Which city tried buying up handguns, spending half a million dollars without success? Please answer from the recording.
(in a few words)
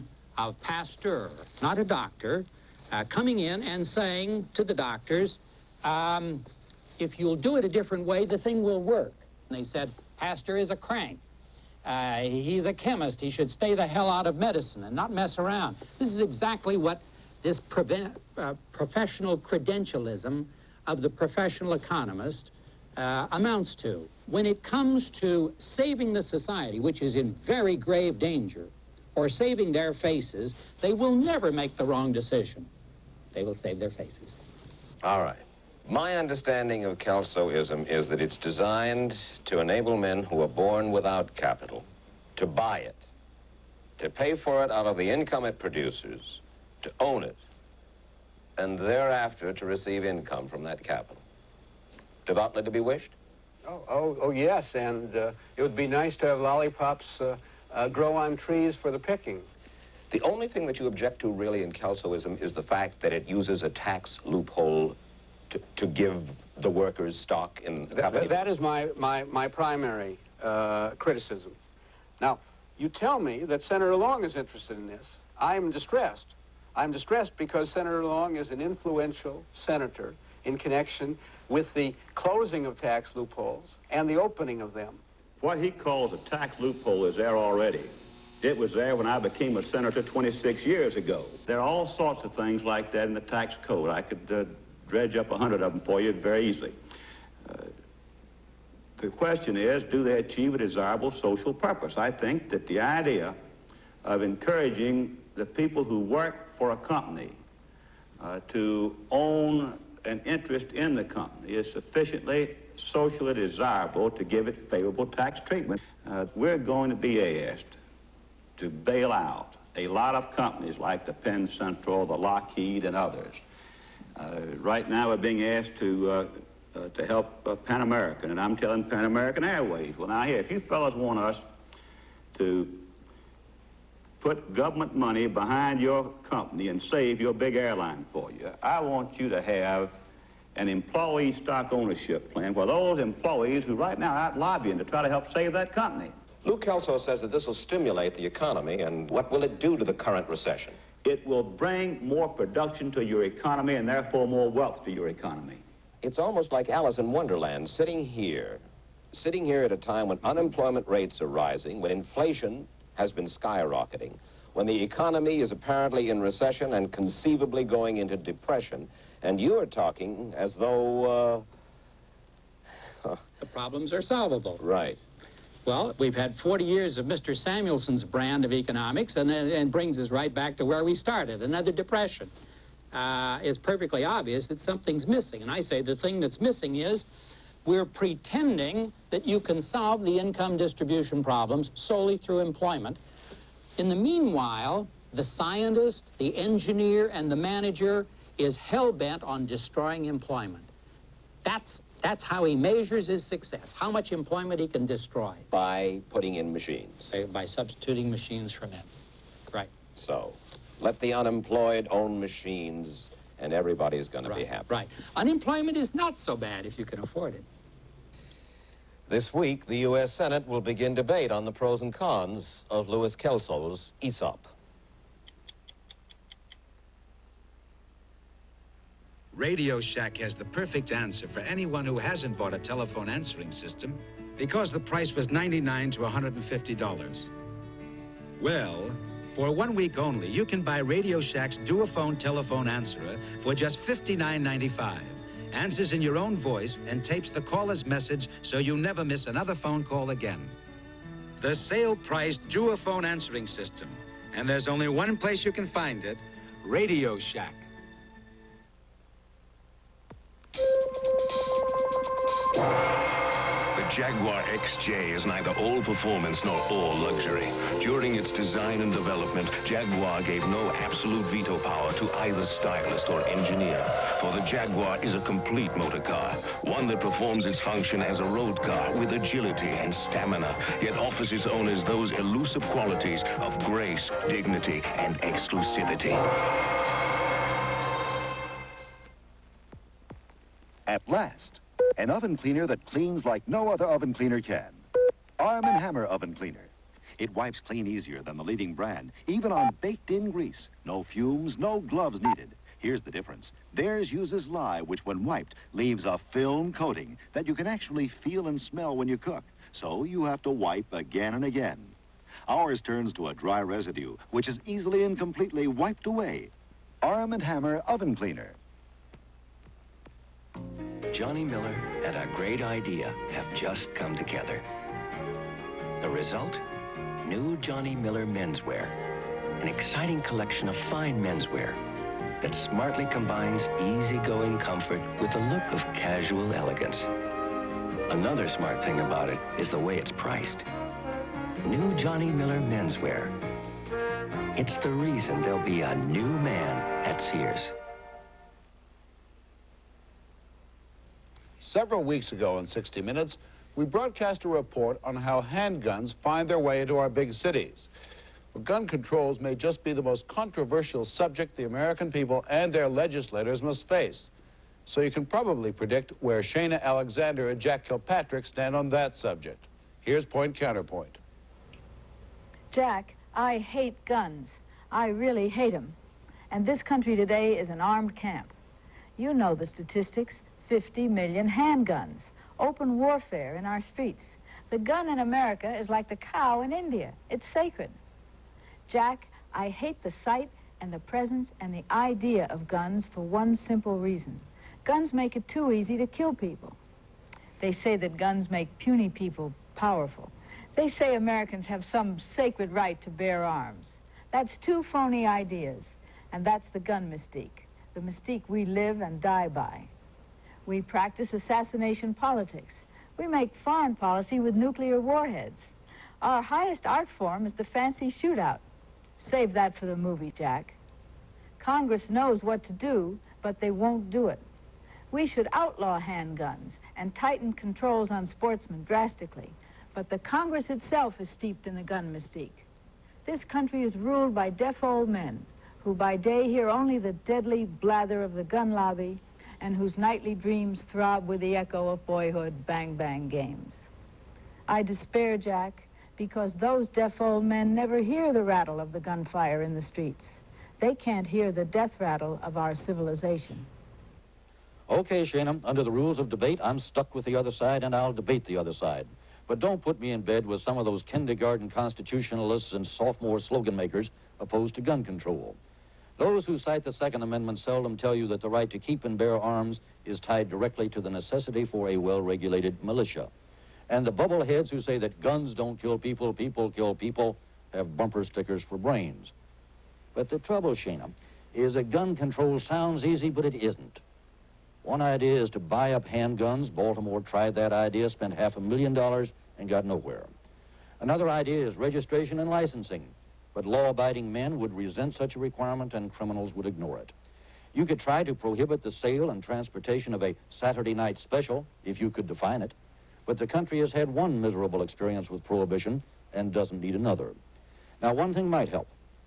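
Baltimore.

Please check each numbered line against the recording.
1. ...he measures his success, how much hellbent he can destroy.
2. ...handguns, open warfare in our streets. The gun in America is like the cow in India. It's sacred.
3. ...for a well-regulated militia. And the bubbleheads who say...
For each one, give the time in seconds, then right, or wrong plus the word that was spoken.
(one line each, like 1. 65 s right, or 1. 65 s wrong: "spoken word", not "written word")
1. 202 s wrong: "employment", not "hellbent"
2. 381 s right
3. 471 s right.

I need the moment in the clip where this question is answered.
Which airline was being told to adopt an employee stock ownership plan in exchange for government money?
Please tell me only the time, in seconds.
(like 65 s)
128 s.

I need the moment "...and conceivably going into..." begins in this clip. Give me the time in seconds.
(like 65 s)
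166 s.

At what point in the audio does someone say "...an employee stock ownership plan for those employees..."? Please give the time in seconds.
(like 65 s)
140 s.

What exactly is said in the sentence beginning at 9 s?
And they said, Pasteur is a crank.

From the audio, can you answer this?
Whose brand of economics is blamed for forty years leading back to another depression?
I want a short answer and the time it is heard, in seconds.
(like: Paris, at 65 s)
Samuelson, at 177 s.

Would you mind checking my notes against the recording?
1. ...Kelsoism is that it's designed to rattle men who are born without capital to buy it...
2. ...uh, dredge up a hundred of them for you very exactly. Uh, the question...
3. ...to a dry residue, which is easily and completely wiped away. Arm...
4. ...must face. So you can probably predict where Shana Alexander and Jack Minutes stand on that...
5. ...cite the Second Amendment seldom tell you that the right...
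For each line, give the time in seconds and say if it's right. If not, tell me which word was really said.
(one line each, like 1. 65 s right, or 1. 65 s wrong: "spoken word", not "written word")
1. 36 s wrong: "enable", not "rattle"
2. 94 s wrong: "easily", not "exactly"
3. 313 s right
4. 363 s wrong: "Kilpatrick", not "Minutes"
5. 466 s right.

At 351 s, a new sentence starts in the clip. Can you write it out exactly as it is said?
Several weeks ago in 60 Minutes, we broadcast a report on how handguns find their way into our big cities.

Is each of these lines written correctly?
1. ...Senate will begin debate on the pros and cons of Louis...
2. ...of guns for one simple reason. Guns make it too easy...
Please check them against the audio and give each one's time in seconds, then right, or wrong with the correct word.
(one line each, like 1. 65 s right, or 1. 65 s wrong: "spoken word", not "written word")
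1. 220 s right
2. 392 s right.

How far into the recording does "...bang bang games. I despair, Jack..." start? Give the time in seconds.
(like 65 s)
442 s.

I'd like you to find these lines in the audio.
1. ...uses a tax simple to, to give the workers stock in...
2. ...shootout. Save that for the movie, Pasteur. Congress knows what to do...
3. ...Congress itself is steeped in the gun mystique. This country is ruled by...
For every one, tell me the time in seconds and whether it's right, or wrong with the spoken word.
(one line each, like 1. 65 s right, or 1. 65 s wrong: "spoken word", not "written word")
1. 63 s wrong: "loophole", not "simple"
2. 418 s wrong: "Jack", not "Pasteur"
3. 430 s right.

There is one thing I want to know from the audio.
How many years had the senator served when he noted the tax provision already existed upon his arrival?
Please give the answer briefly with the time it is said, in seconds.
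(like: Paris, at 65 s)
26, at 90 s.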